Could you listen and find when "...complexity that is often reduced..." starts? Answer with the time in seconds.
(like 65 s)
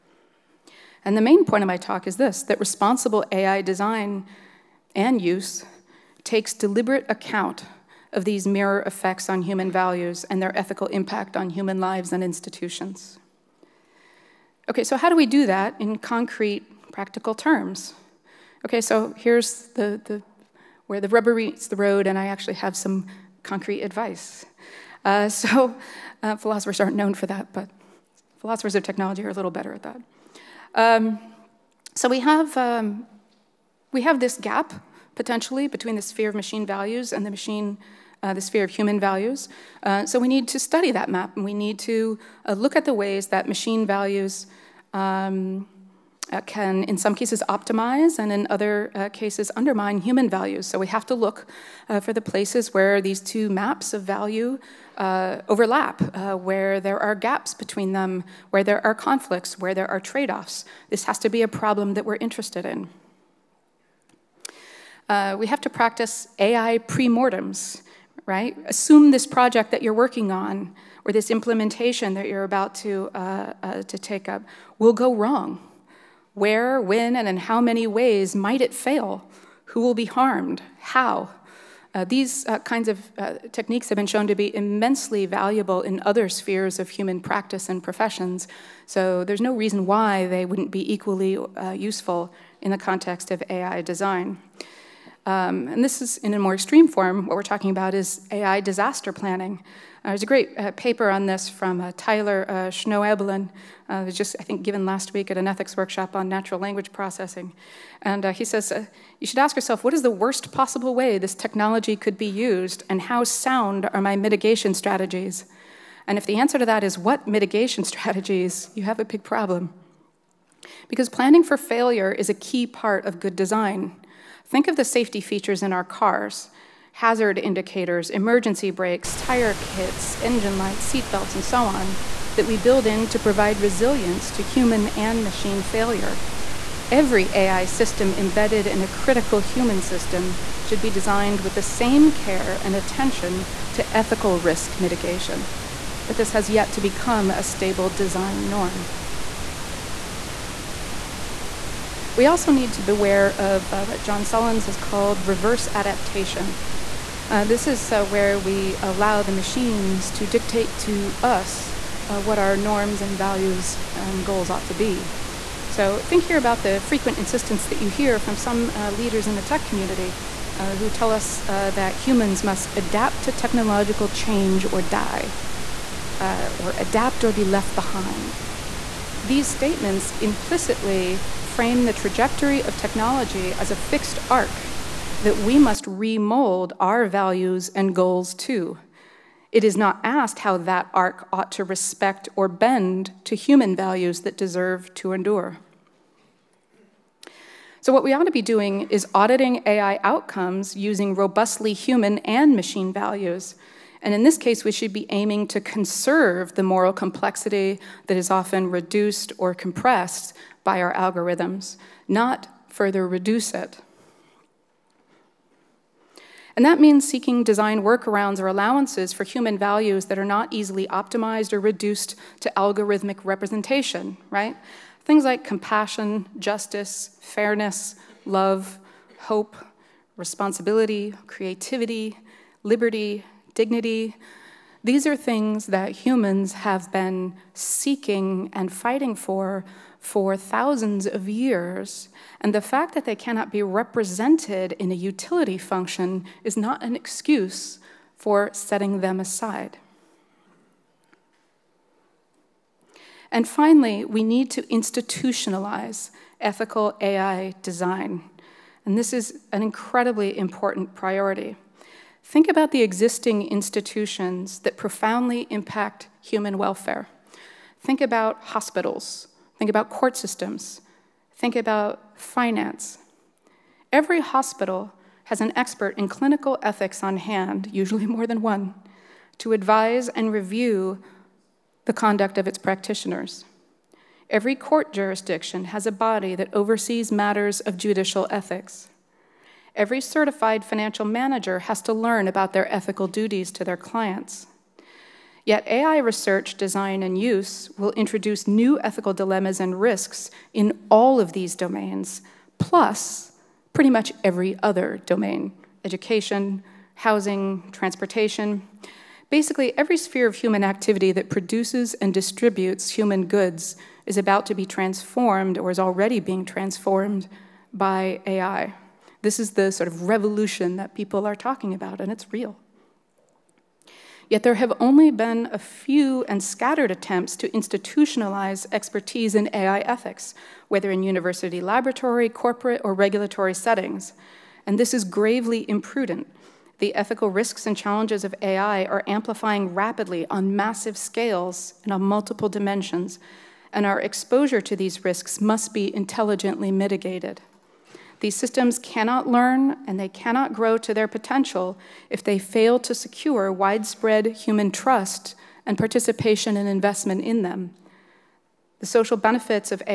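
206 s.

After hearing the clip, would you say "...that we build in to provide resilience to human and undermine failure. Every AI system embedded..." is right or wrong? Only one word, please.
wrong.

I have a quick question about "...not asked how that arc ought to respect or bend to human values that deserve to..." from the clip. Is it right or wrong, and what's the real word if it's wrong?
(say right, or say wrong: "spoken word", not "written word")
right.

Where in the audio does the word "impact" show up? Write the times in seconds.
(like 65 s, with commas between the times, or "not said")
10 s, 265 s.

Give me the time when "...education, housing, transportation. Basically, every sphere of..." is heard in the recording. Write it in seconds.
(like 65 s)
305 s.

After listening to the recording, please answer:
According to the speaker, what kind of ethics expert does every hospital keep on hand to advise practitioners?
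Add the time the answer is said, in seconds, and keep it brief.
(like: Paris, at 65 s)
clinical ethics, at 276 s.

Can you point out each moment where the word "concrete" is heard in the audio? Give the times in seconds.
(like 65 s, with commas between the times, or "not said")
15 s, 23 s.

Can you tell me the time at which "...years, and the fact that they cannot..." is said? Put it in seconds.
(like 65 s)
241 s.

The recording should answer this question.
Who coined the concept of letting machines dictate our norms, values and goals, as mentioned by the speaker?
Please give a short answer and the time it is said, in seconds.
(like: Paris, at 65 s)
John Sullins, at 154 s.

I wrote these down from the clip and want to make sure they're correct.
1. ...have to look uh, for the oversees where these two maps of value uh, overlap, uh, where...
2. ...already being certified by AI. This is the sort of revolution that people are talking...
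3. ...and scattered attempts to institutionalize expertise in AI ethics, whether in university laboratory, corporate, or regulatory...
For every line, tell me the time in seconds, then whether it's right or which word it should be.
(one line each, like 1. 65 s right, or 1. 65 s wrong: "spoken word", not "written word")
1. 50 s wrong: "places", not "oversees"
2. 315 s wrong: "transformed", not "certified"
3. 326 s right.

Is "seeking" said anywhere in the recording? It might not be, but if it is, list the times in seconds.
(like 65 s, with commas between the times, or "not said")
217 s, 237 s.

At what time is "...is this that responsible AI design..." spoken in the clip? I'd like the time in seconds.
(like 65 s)
2 s.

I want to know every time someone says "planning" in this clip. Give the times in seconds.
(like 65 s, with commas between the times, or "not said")
99 s, 121 s.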